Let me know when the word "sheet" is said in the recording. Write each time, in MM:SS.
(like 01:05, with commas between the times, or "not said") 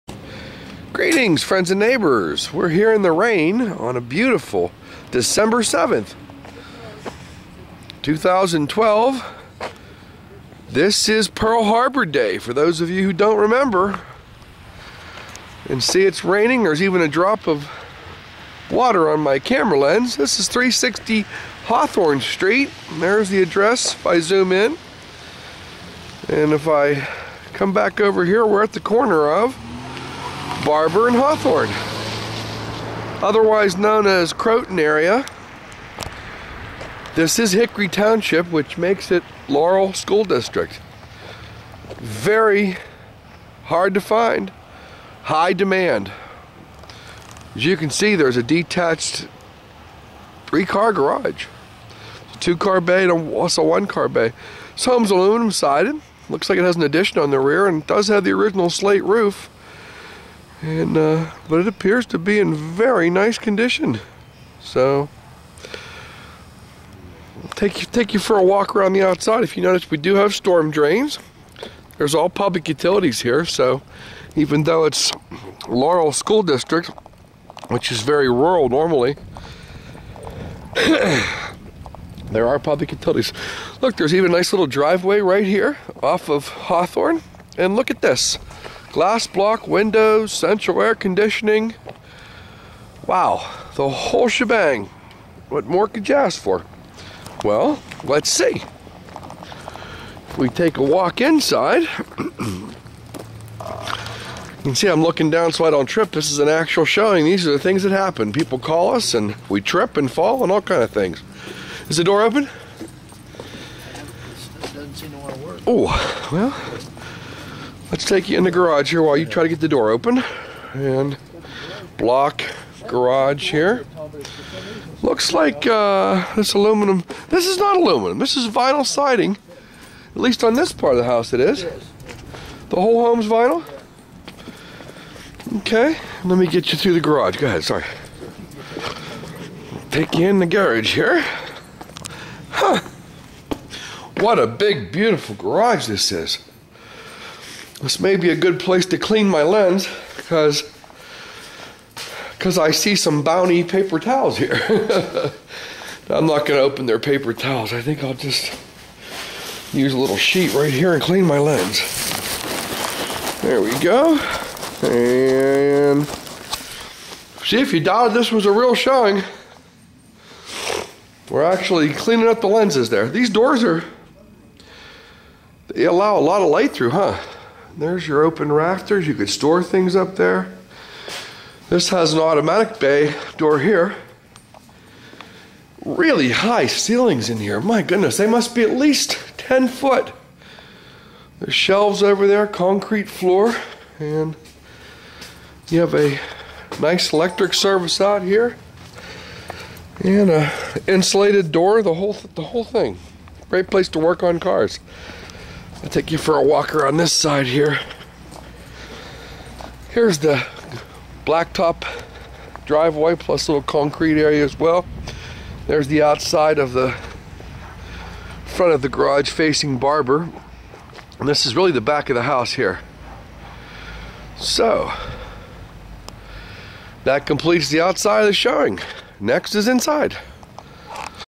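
02:40.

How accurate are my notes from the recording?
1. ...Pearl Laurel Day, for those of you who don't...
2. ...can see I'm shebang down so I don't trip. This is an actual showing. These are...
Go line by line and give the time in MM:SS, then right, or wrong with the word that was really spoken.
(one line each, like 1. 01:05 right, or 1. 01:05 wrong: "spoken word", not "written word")
1. 00:11 wrong: "Harbor", not "Laurel"
2. 01:44 wrong: "looking", not "shebang".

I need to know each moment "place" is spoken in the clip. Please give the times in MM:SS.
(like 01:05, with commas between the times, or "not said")
02:28, 03:23.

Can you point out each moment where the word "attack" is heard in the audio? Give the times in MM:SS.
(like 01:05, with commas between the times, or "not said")
not said.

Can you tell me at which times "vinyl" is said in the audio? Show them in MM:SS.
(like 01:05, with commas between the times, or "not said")
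02:08, 02:13.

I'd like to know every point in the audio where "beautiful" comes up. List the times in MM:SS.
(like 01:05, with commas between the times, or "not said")
00:04, 02:24.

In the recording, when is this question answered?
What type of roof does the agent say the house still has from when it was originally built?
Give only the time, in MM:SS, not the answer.
00:58.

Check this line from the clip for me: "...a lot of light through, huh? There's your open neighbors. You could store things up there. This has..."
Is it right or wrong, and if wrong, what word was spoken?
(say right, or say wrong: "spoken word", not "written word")
wrong: "rafters", not "neighbors".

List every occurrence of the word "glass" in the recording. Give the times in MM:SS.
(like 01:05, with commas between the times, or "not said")
01:28.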